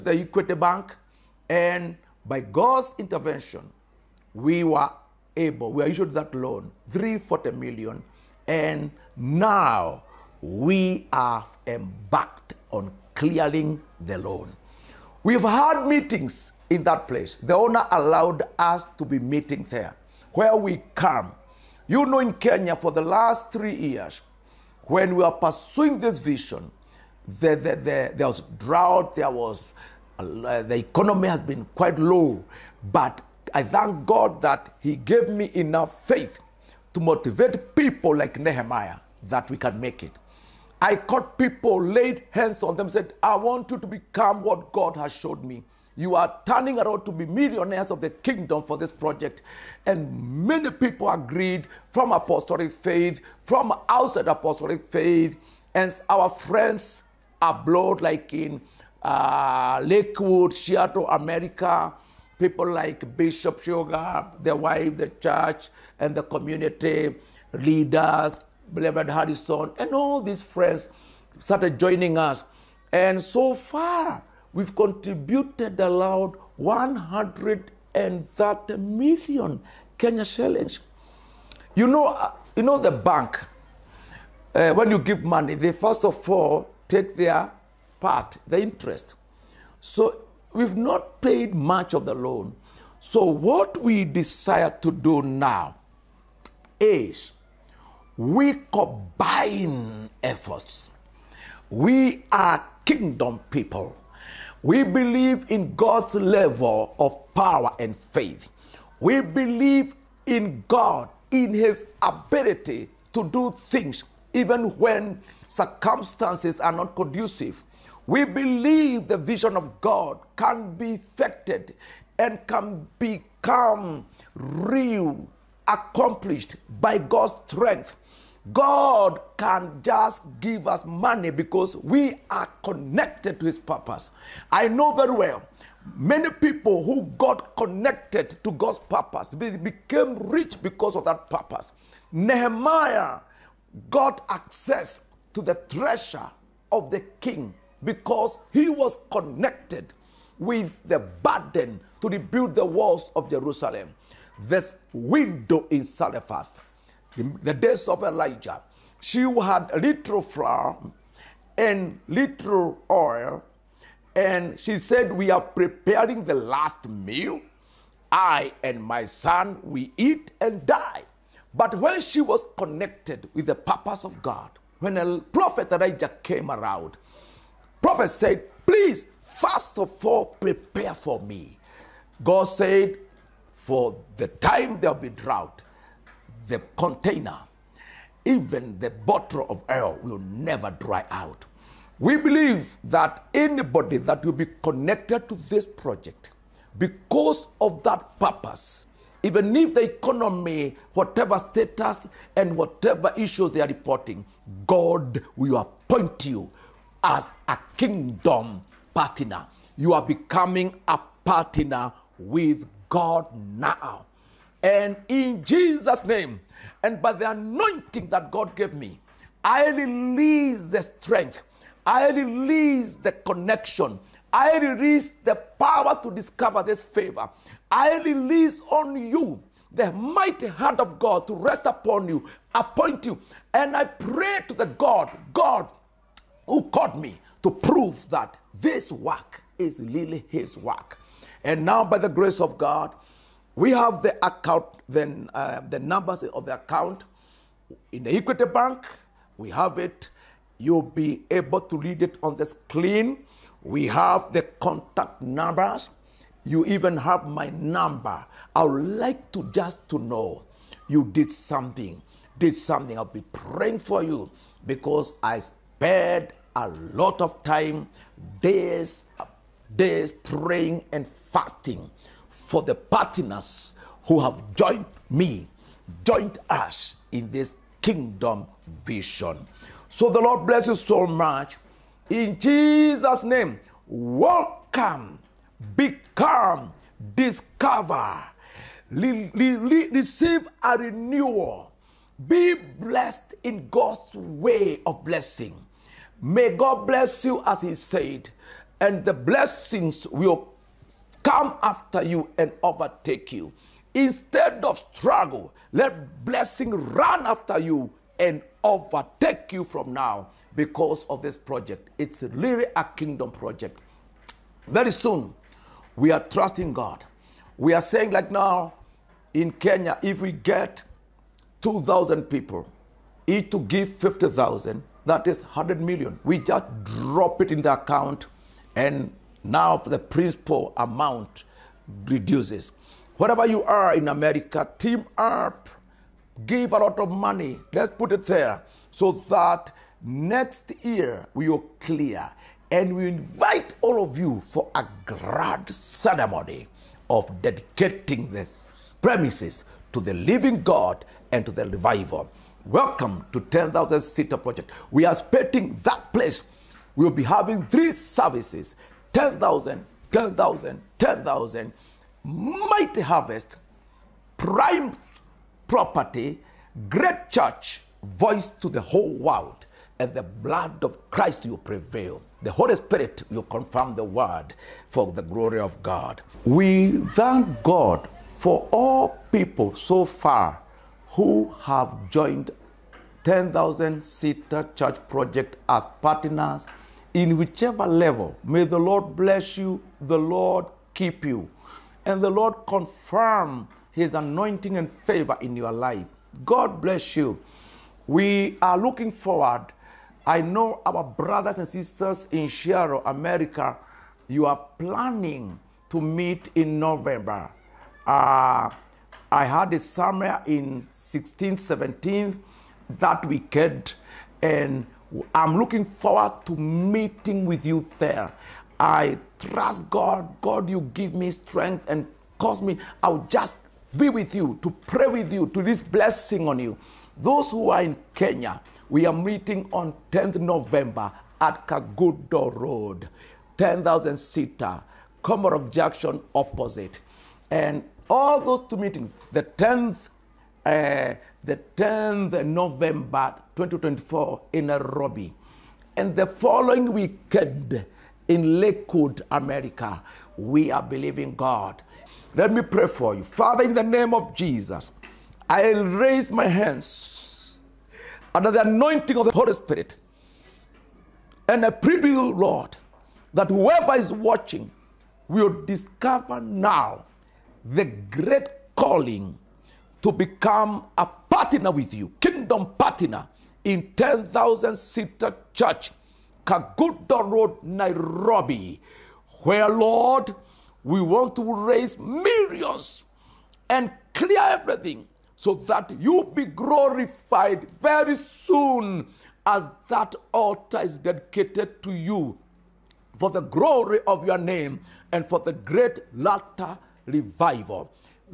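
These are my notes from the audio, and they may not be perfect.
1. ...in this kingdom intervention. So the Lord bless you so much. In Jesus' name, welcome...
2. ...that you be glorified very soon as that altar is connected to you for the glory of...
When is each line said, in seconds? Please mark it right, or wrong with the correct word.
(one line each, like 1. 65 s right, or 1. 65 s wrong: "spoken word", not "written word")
1. 277 s wrong: "vision", not "intervention"
2. 485 s wrong: "dedicated", not "connected".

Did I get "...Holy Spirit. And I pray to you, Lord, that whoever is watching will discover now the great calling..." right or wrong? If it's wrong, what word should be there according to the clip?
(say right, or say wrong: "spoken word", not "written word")
right.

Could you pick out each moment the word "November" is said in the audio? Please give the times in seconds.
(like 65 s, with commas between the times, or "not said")
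406 s, 430 s, 442 s.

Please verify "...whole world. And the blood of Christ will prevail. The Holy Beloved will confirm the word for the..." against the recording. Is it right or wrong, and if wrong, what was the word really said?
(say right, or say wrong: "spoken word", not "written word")
wrong: "Spirit", not "Beloved".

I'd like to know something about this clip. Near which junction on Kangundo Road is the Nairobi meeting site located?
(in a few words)
Komarock Junction.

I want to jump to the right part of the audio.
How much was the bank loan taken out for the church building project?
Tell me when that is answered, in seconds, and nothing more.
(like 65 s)
6 s.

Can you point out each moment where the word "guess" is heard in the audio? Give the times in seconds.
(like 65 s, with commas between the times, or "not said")
not said.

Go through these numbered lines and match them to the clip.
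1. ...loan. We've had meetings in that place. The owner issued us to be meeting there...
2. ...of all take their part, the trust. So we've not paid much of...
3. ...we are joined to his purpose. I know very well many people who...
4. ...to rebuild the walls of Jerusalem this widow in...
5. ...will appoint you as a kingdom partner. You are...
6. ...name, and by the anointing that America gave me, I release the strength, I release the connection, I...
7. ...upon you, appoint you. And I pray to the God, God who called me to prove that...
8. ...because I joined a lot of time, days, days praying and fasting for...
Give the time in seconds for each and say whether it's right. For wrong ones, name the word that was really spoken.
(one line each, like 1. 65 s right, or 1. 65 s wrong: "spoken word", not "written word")
1. 14 s wrong: "allowed", not "issued"
2. 86 s wrong: "interest", not "trust"
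3. 131 s wrong: "connected", not "joined"
4. 152 s right
5. 205 s right
6. 216 s wrong: "God", not "America"
7. 231 s right
8. 264 s wrong: "spared", not "joined".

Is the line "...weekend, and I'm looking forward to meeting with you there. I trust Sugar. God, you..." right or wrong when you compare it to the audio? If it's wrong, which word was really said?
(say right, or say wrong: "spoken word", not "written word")
wrong: "God", not "Sugar".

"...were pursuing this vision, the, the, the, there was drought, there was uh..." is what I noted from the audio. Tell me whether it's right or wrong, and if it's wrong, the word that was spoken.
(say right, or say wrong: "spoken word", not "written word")
right.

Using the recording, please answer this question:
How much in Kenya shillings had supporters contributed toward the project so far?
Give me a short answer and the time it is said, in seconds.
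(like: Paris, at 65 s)
130 million, at 76 s.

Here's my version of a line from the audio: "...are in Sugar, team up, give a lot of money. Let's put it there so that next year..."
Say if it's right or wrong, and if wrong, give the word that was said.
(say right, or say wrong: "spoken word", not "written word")
wrong: "America", not "Sugar".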